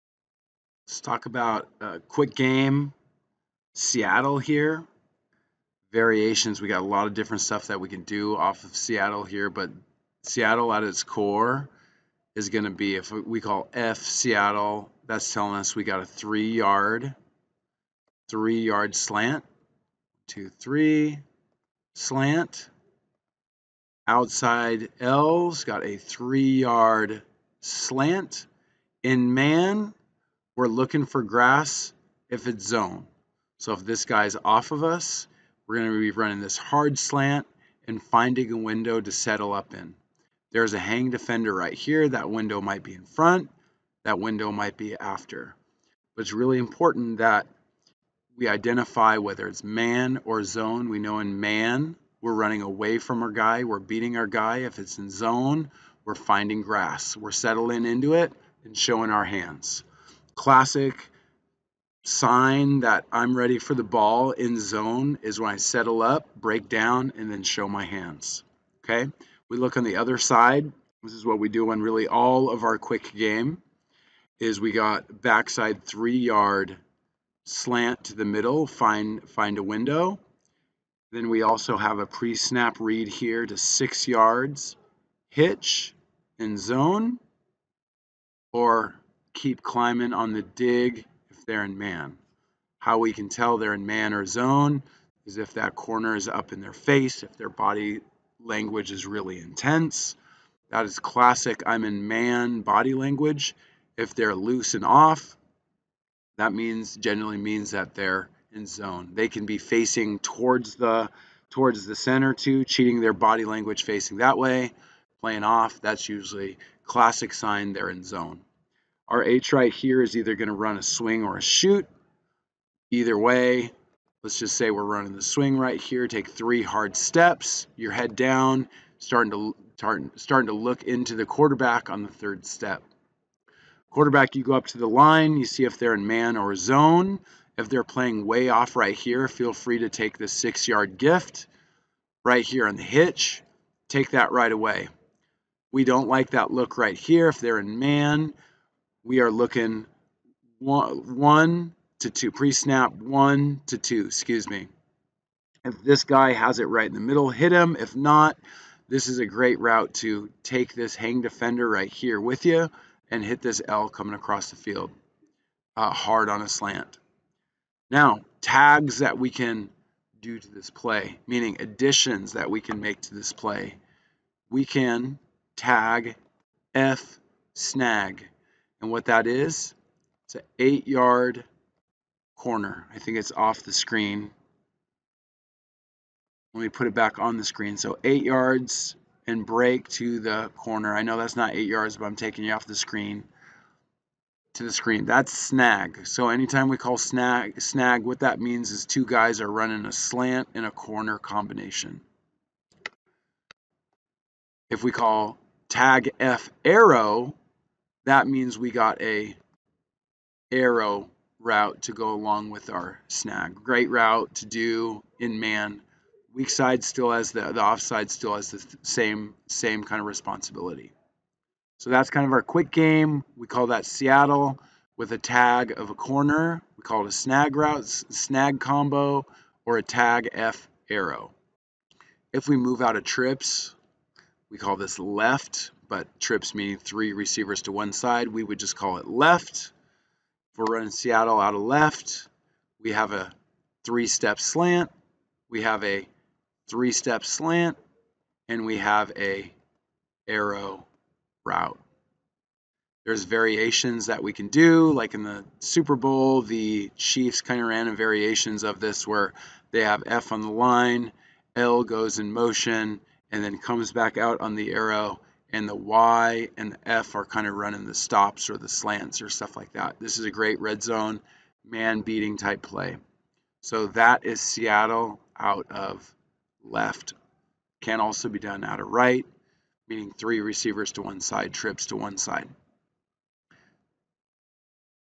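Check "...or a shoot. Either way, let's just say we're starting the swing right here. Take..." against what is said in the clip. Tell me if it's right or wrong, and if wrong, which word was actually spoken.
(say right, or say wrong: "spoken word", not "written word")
wrong: "running", not "starting".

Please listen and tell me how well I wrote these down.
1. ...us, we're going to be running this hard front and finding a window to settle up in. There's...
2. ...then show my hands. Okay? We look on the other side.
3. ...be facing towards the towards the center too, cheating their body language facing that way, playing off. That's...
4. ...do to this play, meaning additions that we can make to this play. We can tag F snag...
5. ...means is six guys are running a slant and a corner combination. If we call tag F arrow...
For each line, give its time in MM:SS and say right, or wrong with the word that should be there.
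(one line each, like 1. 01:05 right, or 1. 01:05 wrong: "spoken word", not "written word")
1. 00:34 wrong: "slant", not "front"
2. 01:07 right
3. 01:49 right
4. 02:50 right
5. 03:18 wrong: "two", not "six".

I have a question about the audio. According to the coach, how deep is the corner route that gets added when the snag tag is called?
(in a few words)
8 yards.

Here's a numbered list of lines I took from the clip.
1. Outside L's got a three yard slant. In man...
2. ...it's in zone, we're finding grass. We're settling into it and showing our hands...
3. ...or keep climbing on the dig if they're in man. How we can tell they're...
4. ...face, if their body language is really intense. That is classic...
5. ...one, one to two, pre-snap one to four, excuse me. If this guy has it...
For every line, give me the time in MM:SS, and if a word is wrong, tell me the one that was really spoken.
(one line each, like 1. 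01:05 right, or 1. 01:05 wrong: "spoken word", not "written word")
1. 00:24 right
2. 00:54 right
3. 01:28 right
4. 01:36 right
5. 02:30 wrong: "two", not "four".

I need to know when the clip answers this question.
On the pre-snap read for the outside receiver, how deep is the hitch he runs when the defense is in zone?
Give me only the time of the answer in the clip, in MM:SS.
01:23.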